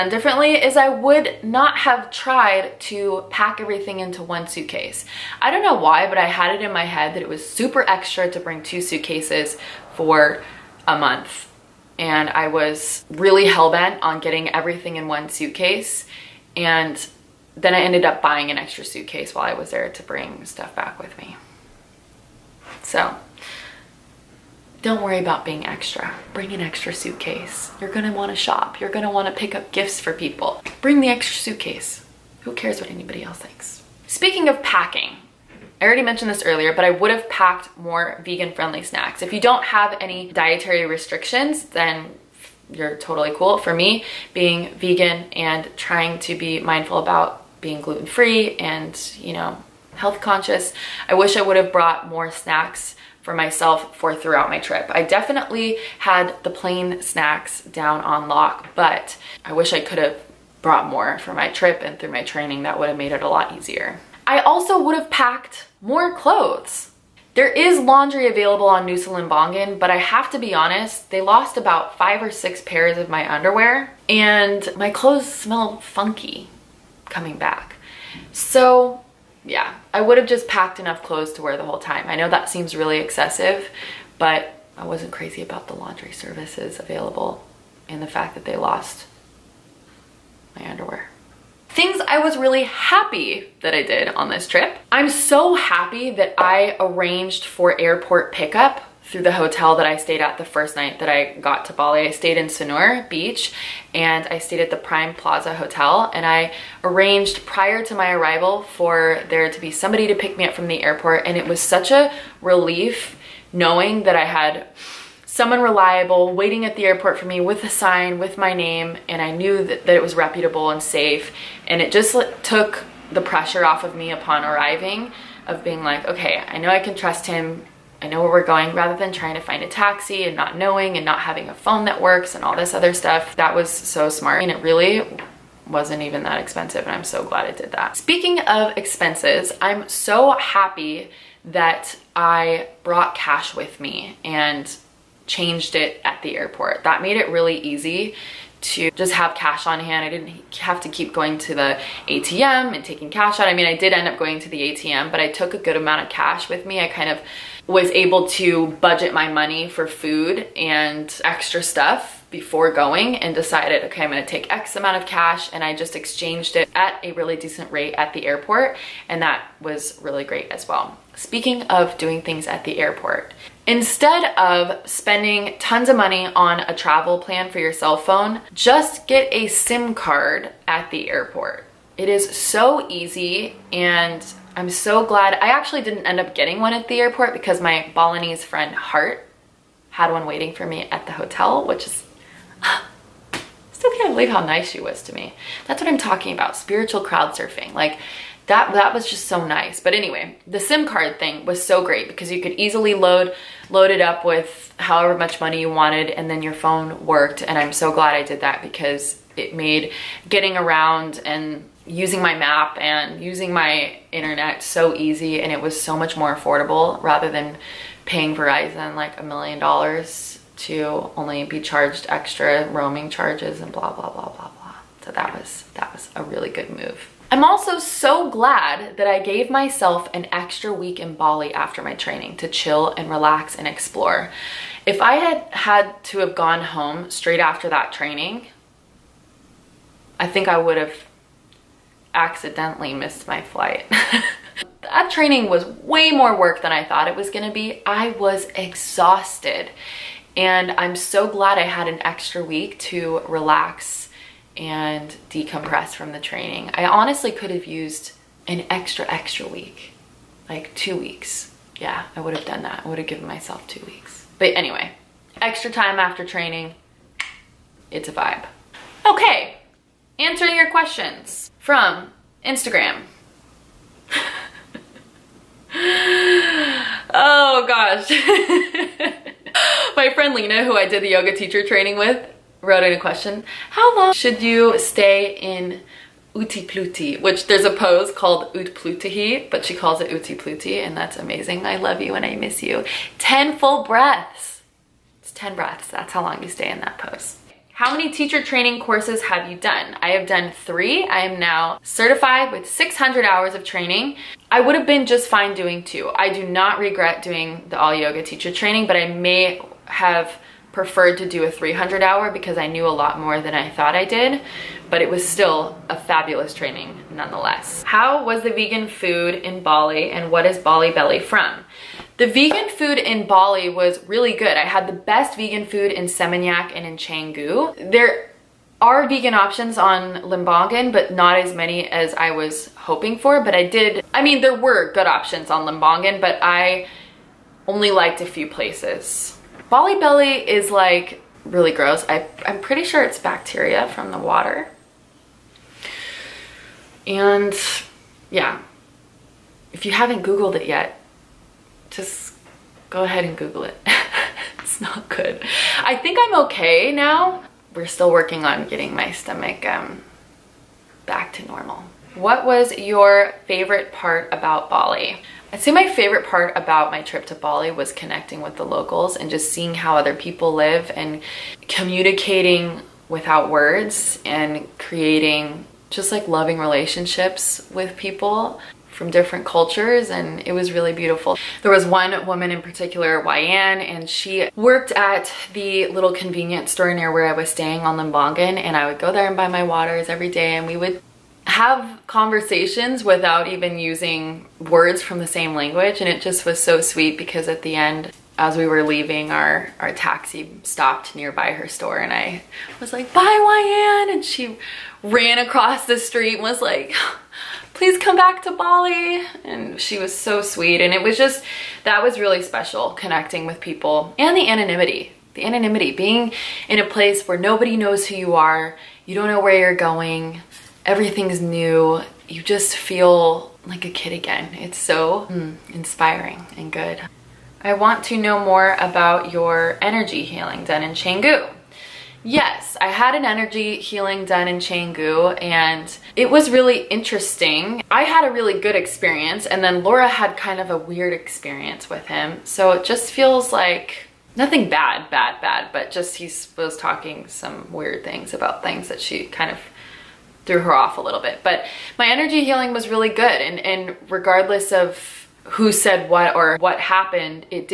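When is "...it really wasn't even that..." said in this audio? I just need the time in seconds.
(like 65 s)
134 s.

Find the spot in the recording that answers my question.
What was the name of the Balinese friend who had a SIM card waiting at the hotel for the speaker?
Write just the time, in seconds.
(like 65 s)
188 s.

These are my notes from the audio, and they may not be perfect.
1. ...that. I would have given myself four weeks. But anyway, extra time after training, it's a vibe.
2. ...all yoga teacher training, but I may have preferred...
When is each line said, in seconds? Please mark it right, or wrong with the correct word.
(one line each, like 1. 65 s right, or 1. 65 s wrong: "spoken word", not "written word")
1. 262 s wrong: "two", not "four"
2. 307 s right.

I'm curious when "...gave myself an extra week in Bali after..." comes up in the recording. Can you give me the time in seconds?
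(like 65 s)
229 s.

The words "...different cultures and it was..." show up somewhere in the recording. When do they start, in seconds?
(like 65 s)
379 s.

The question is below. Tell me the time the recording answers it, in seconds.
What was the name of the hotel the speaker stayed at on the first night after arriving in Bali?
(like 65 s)
104 s.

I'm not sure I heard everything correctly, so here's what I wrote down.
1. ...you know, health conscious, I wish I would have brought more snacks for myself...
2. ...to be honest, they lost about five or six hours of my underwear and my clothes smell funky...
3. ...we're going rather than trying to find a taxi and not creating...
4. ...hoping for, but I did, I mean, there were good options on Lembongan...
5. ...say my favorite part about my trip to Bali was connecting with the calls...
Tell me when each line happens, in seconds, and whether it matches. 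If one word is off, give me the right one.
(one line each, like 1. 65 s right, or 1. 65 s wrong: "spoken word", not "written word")
1. 49 s right
2. 70 s wrong: "pairs", not "hours"
3. 128 s wrong: "knowing", not "creating"
4. 332 s right
5. 365 s wrong: "locals", not "calls".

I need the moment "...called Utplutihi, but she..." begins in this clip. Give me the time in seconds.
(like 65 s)
288 s.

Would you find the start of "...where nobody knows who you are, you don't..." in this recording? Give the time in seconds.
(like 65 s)
417 s.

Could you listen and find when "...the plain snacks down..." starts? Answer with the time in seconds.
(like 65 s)
56 s.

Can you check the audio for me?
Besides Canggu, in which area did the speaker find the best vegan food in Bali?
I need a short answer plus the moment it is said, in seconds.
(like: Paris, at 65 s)
Seminyak, at 326 s.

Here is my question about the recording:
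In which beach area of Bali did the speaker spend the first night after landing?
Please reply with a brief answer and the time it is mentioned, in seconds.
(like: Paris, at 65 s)
Sanur Beach, at 102 s.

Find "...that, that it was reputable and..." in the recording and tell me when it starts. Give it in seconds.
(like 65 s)
119 s.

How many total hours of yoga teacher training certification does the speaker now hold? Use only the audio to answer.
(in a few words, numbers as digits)
600.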